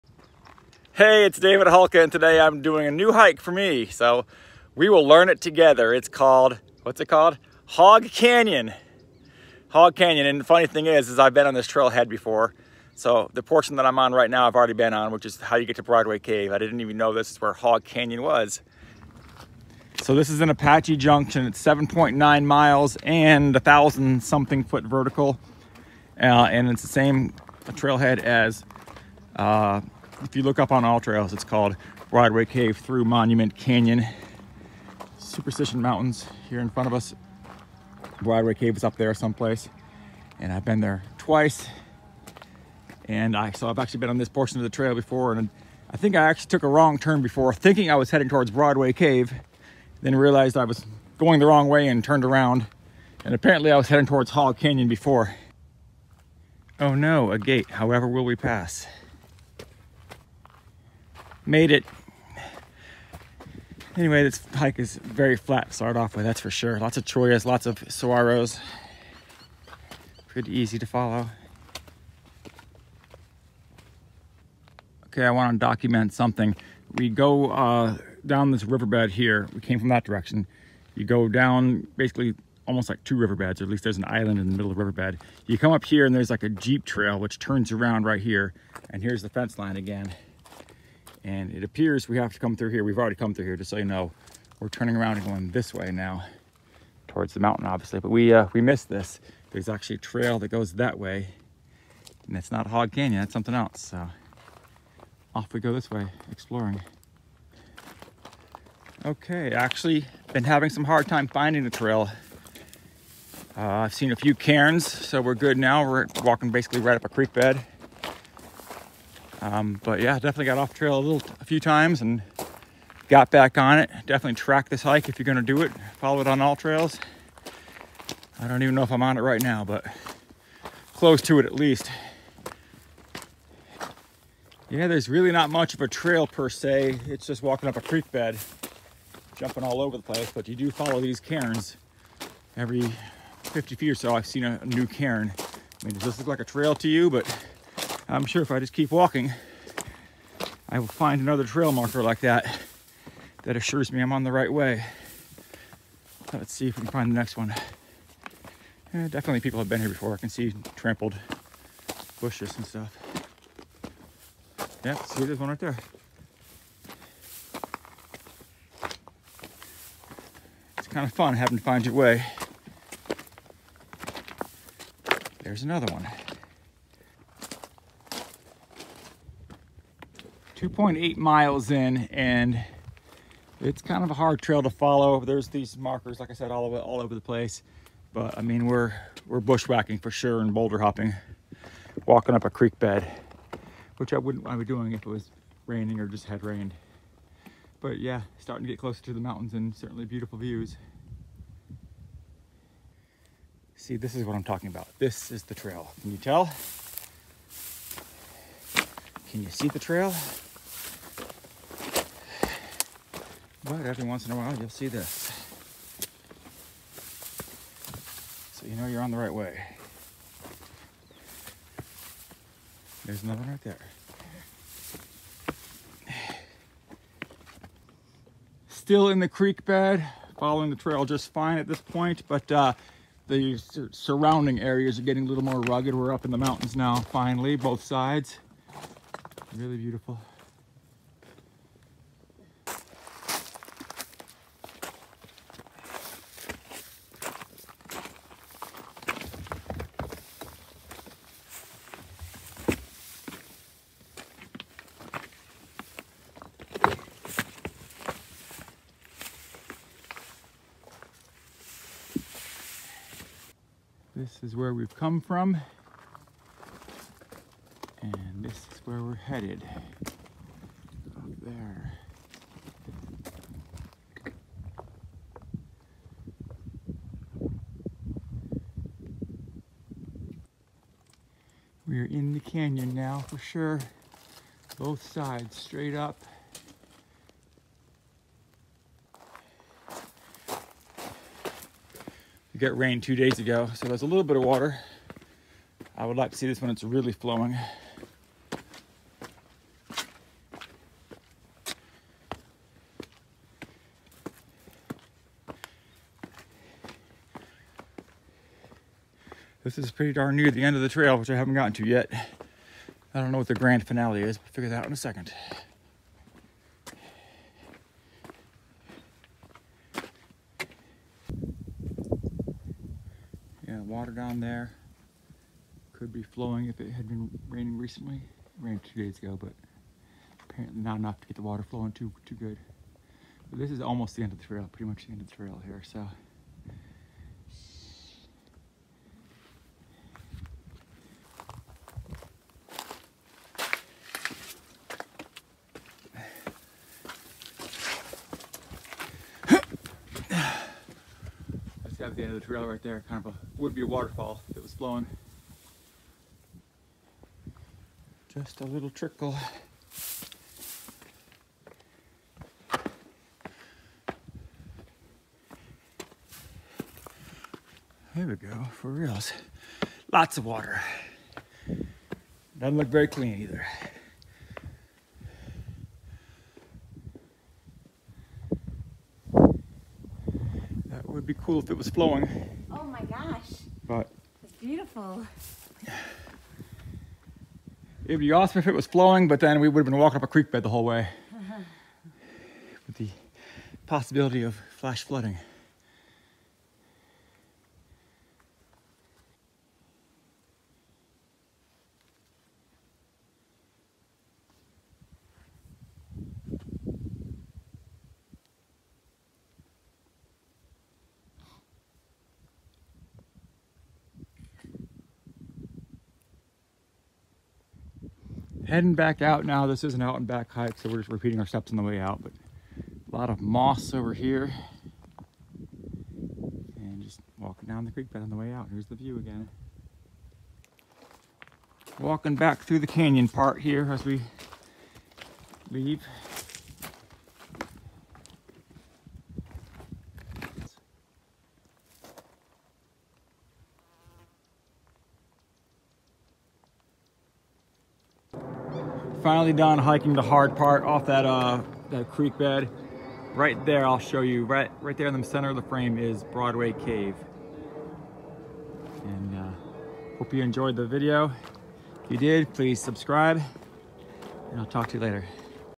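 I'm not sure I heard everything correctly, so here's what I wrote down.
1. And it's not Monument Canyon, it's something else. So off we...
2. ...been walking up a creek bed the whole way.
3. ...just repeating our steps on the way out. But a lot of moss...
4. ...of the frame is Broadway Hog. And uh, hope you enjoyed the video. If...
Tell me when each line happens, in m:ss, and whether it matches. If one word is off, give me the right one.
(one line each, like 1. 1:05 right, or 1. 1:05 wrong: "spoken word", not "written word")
1. 1:42 wrong: "Hog", not "Monument"
2. 6:29 right
3. 7:00 right
4. 7:35 wrong: "Cave", not "Hog".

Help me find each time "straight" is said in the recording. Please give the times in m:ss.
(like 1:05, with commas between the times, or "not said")
4:45.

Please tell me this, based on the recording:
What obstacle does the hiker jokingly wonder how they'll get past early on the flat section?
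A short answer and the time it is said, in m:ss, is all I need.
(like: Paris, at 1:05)
A gate, at 0:57.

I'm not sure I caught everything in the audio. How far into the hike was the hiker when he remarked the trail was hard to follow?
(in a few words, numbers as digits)
2.8 miles.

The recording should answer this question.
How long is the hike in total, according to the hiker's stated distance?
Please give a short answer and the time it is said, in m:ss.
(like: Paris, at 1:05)
7.9 miles, at 0:21.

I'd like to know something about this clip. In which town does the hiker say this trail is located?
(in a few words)
Apache Junction.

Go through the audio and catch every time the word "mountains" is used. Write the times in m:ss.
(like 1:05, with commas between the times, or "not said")
0:35, 1:37, 3:19, 3:56.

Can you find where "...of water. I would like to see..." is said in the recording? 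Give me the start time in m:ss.
4:54.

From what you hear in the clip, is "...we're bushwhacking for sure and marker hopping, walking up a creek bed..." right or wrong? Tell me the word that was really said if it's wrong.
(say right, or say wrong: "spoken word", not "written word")
wrong: "boulder", not "marker".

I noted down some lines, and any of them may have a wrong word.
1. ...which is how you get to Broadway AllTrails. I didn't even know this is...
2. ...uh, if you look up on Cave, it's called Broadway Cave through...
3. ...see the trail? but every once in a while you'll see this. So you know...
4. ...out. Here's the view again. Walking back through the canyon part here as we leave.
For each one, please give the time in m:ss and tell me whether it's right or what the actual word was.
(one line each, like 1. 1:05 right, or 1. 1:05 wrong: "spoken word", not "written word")
1. 0:15 wrong: "Cave", not "AllTrails"
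2. 0:29 wrong: "AllTrails", not "Cave"
3. 3:29 right
4. 7:08 right.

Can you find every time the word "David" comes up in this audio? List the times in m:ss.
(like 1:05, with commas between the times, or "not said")
0:01.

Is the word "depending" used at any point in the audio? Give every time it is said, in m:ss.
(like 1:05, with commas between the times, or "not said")
not said.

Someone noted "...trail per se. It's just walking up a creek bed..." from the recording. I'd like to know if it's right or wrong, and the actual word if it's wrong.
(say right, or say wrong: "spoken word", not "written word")
right.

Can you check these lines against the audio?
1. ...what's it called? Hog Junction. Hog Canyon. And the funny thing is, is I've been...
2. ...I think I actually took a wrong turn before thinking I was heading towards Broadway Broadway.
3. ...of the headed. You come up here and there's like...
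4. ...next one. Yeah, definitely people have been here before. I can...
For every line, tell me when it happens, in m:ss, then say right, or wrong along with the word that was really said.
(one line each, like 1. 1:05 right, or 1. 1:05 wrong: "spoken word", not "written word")
1. 0:06 wrong: "Canyon", not "Junction"
2. 0:45 wrong: "Cave", not "Broadway"
3. 1:24 wrong: "riverbed", not "headed"
4. 2:37 right.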